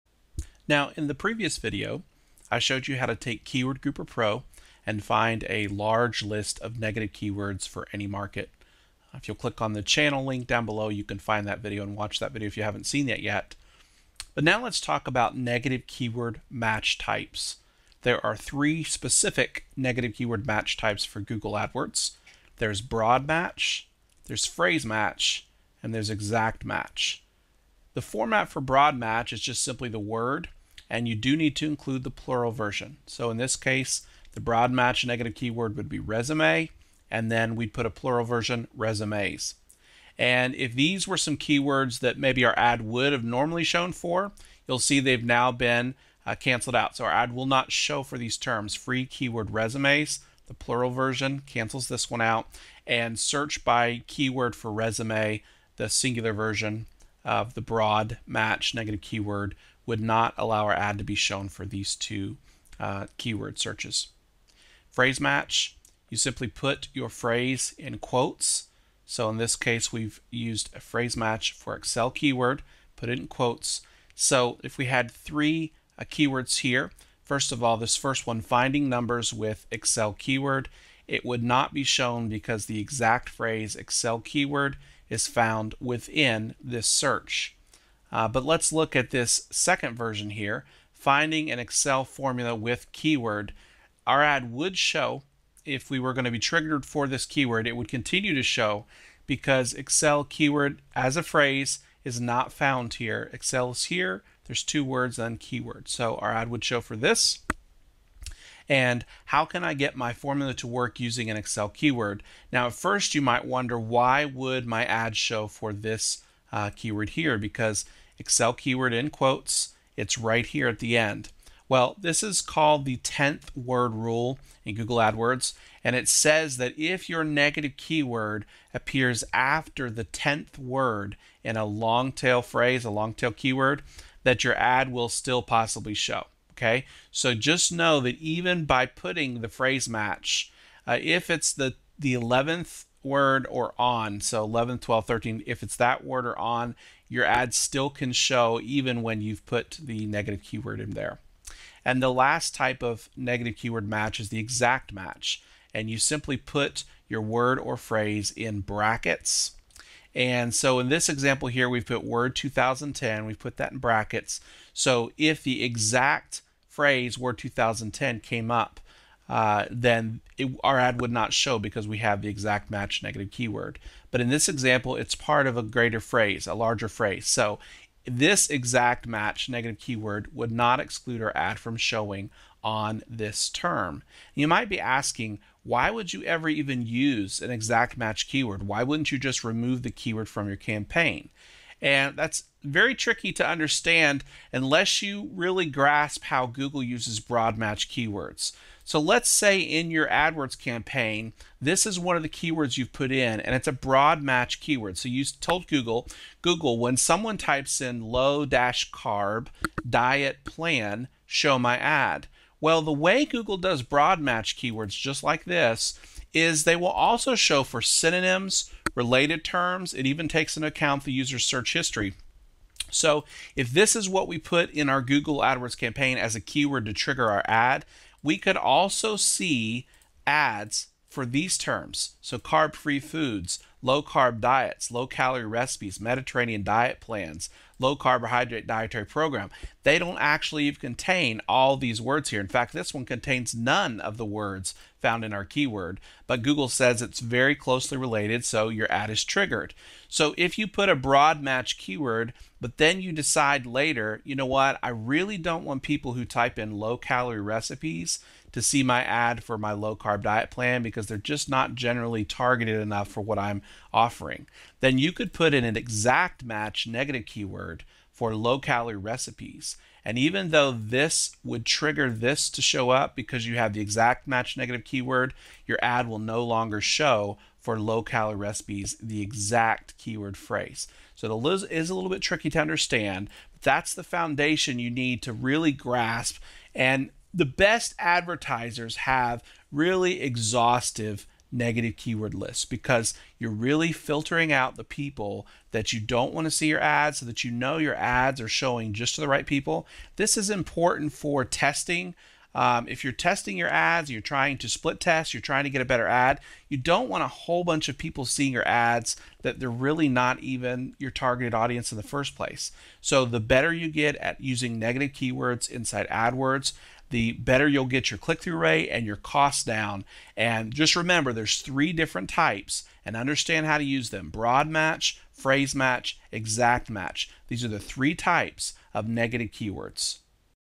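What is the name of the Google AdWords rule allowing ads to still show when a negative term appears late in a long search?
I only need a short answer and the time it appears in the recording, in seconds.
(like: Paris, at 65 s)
10th word rule, at 122 s.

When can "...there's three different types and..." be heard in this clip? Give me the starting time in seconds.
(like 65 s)
321 s.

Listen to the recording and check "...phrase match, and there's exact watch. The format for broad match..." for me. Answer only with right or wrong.
wrong.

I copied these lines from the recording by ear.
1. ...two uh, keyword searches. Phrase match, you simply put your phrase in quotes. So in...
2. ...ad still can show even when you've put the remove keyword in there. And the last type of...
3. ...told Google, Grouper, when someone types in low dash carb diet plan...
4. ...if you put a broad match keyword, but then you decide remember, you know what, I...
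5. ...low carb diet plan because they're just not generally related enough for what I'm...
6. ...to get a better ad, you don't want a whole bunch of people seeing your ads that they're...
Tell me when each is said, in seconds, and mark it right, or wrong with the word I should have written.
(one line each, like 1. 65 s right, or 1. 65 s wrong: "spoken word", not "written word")
1. 61 s right
2. 147 s wrong: "negative", not "remove"
3. 205 s wrong: "Google", not "Grouper"
4. 250 s wrong: "later", not "remember"
5. 259 s wrong: "targeted", not "related"
6. 305 s right.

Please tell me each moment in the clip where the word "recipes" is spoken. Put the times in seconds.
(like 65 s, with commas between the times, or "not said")
235 s, 257 s, 268 s, 278 s.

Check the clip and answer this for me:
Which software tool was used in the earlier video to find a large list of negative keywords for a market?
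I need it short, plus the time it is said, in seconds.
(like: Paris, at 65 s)
Keyword Grouper Pro, at 3 s.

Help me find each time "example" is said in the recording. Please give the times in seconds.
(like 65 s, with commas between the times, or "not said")
161 s, 174 s.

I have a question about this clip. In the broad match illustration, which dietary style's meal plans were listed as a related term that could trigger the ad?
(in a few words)
Mediterranean.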